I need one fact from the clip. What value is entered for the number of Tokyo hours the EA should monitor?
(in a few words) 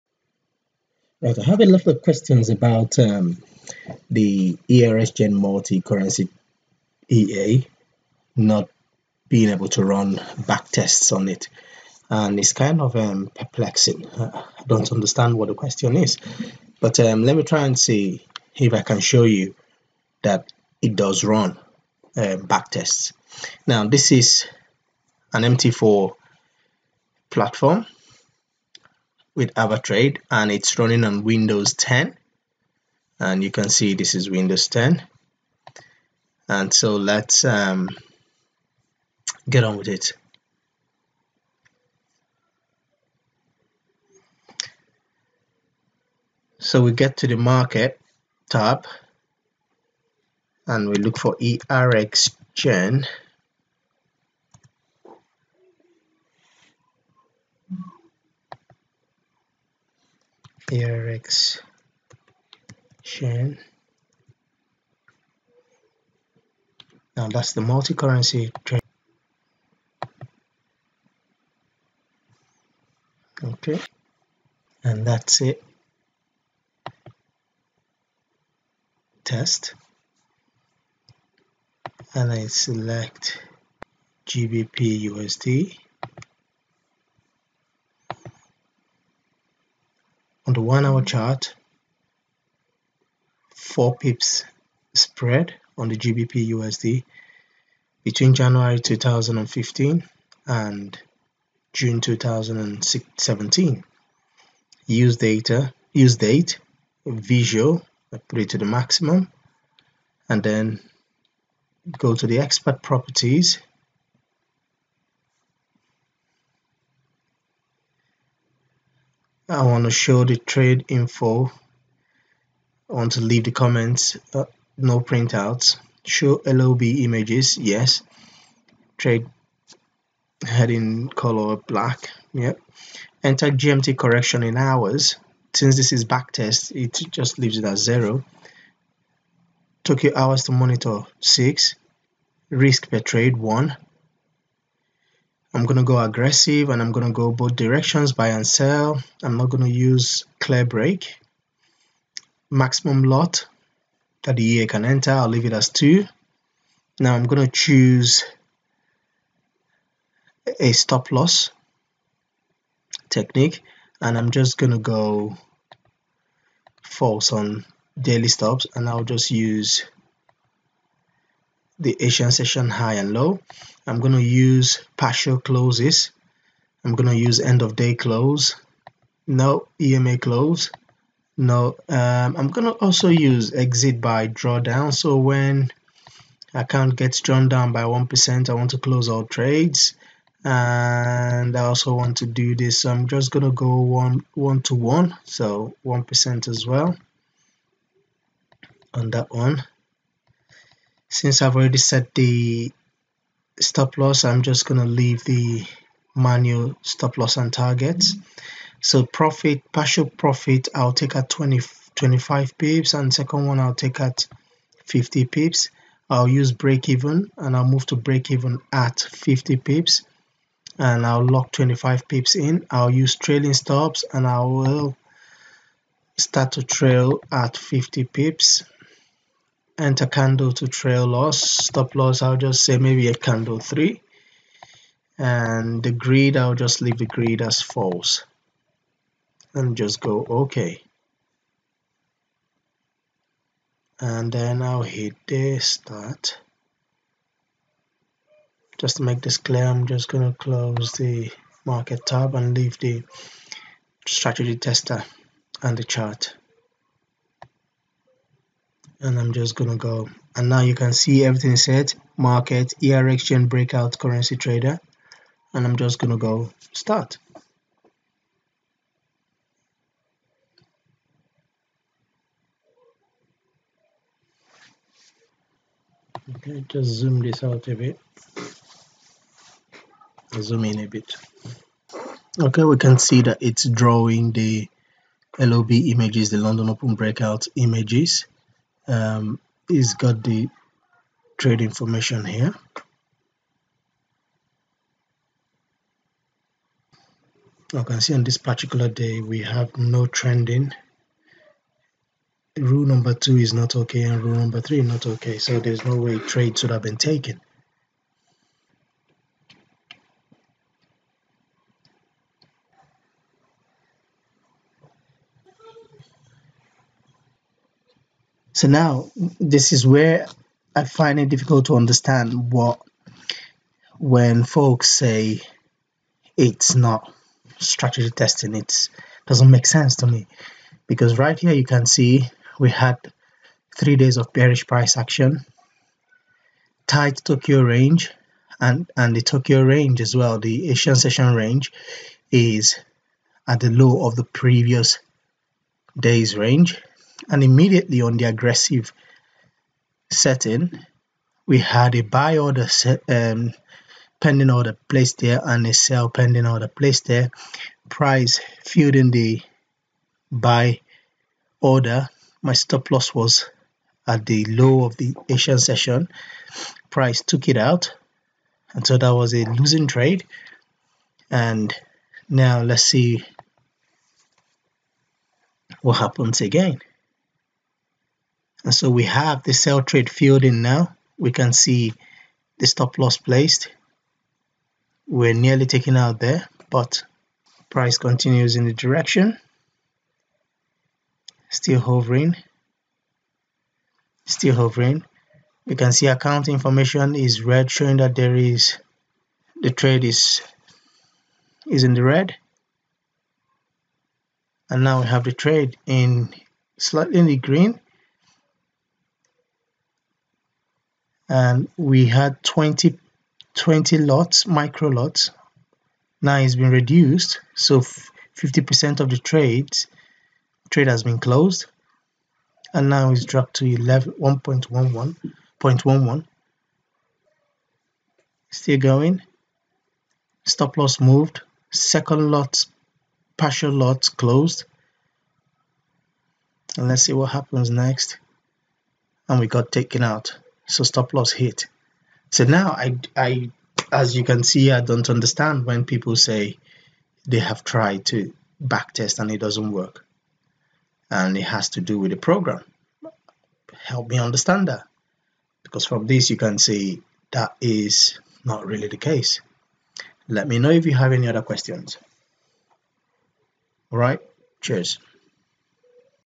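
6.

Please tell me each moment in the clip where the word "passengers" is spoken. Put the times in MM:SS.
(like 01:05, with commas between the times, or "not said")
not said.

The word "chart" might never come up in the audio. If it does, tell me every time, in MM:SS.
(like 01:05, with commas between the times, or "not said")
01:31, 04:15.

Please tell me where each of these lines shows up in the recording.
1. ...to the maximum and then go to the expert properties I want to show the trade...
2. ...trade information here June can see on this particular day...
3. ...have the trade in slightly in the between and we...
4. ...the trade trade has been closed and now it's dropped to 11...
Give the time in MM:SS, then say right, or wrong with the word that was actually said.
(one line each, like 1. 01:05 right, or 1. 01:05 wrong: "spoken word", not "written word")
1. 01:48 right
2. 04:51 wrong: "You", not "June"
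3. 06:45 wrong: "green", not "between"
4. 06:59 right.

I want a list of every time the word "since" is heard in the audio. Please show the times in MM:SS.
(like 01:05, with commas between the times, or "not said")
02:15, 03:21.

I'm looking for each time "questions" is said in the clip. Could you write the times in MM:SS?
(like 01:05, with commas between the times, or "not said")
00:02, 00:15, 07:41.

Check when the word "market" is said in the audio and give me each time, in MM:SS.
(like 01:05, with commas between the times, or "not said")
00:47, 04:11, 04:22.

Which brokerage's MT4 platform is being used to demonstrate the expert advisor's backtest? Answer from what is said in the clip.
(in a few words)
AvaTrade.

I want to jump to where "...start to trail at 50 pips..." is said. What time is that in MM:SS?
03:46.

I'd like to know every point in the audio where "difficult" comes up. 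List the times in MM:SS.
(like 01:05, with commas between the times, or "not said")
05:21.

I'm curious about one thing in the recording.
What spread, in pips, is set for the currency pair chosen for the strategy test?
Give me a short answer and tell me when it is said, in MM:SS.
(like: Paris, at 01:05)
4 pips, at 01:33.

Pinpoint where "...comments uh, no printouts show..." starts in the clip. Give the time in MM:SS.
02:03.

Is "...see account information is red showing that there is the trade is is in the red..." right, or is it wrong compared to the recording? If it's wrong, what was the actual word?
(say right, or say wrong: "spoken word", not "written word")
right.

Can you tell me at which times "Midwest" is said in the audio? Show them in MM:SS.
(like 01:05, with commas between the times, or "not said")
not said.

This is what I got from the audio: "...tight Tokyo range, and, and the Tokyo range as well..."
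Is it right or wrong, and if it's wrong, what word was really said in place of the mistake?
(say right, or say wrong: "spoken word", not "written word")
right.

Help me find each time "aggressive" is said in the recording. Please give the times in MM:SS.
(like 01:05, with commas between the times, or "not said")
02:26, 05:48.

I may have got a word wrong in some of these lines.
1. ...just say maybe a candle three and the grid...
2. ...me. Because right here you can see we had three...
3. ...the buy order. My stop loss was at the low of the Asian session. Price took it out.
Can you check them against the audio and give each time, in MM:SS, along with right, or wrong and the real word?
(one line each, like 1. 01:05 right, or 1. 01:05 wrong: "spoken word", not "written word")
1. 03:52 right
2. 05:30 right
3. 05:59 right.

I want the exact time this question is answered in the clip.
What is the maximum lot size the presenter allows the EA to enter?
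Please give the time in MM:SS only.
02:35.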